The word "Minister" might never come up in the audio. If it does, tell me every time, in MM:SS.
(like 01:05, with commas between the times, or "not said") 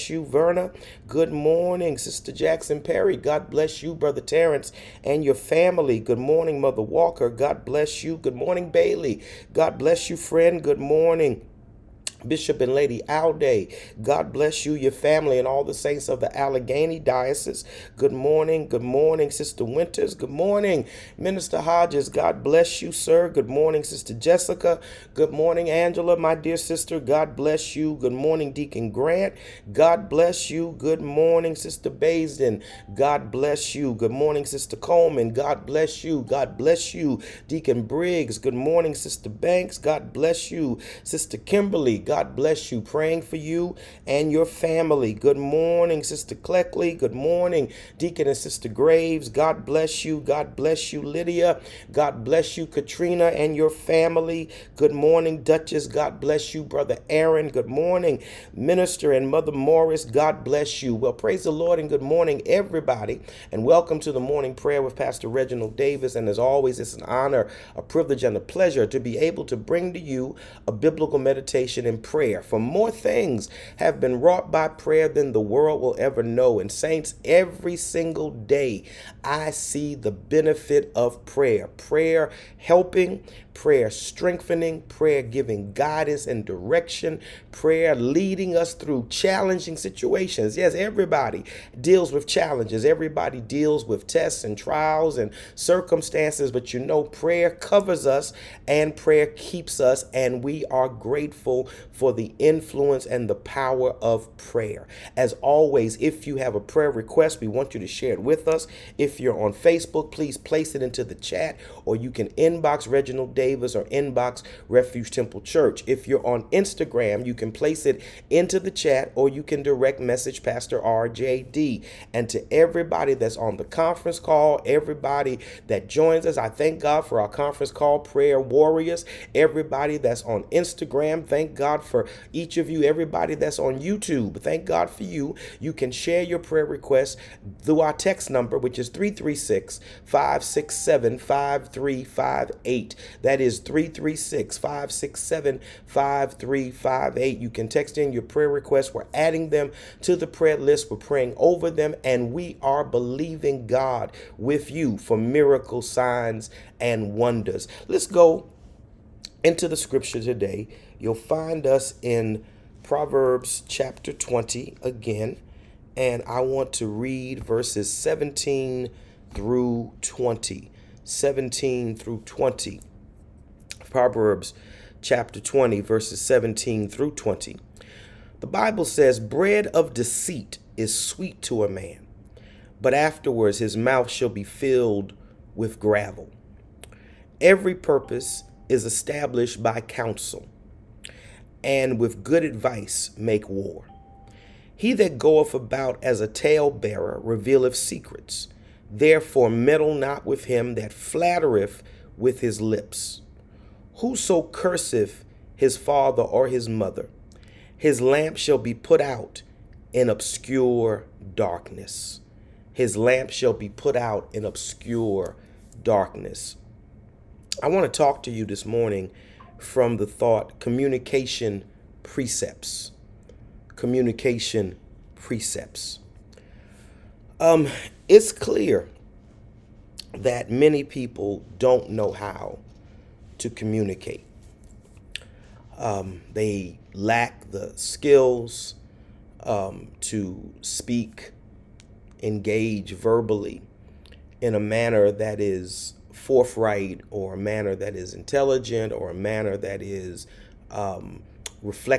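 00:21, 00:58.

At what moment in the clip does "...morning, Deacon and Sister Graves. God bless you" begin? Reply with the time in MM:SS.
00:47.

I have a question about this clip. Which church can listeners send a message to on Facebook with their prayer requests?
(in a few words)
Refuge Temple Church.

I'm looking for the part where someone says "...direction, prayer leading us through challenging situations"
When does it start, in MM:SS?
01:26.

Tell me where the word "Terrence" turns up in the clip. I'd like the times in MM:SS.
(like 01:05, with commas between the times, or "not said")
00:04.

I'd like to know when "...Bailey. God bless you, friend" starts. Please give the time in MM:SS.
00:08.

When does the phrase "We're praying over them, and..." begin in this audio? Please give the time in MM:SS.
02:30.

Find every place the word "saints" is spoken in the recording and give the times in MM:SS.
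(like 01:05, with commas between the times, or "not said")
00:15, 01:16.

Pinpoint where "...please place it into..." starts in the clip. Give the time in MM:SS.
01:50.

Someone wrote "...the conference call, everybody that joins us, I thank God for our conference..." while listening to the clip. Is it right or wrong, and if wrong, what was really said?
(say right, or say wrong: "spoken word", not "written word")
right.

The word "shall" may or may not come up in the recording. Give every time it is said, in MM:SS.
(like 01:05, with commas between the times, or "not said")
03:04, 03:28, 03:33.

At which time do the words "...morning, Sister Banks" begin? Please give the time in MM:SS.
00:38.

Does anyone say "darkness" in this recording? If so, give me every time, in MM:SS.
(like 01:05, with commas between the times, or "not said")
03:31, 03:35.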